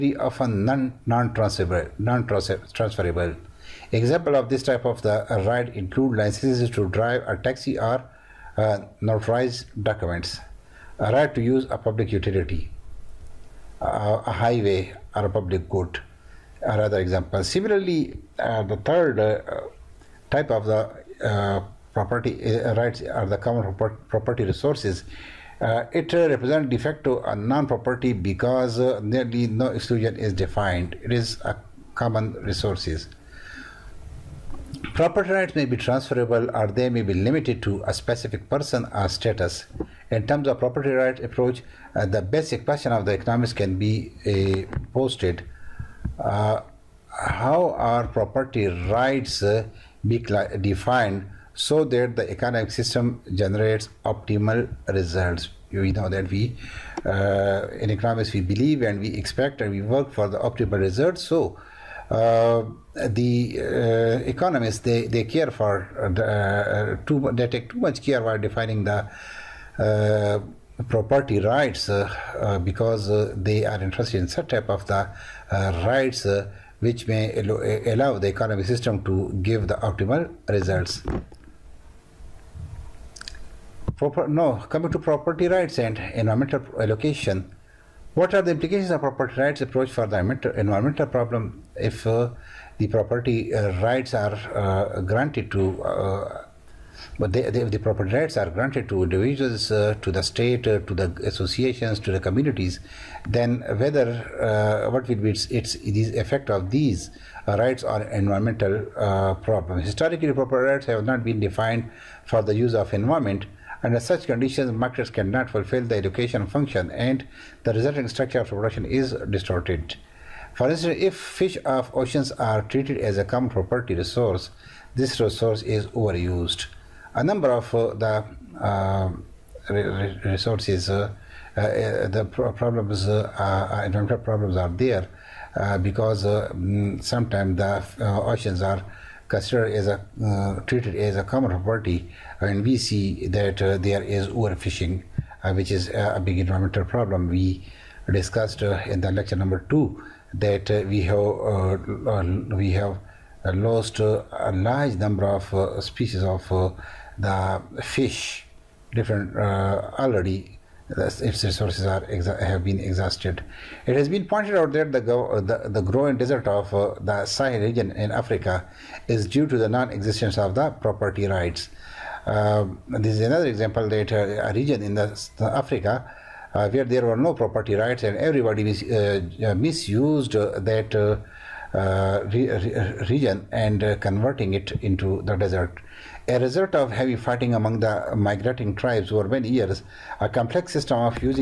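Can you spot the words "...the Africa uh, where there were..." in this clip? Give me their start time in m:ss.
2:54.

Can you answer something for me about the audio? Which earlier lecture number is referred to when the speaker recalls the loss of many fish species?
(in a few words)
2.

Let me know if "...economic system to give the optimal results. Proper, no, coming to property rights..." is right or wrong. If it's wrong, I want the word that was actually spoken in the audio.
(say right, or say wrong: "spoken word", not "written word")
right.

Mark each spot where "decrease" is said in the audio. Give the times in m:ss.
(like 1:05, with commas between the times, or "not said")
not said.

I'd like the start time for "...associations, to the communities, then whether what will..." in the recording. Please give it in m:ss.
1:41.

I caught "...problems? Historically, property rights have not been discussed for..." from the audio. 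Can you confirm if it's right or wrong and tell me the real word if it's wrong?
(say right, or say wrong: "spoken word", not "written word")
wrong: "defined", not "discussed".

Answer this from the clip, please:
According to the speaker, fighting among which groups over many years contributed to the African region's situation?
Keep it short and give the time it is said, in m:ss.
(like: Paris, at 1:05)
Migrating tribes, at 3:08.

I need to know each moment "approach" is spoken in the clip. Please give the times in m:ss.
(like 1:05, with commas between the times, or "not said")
0:41, 1:29.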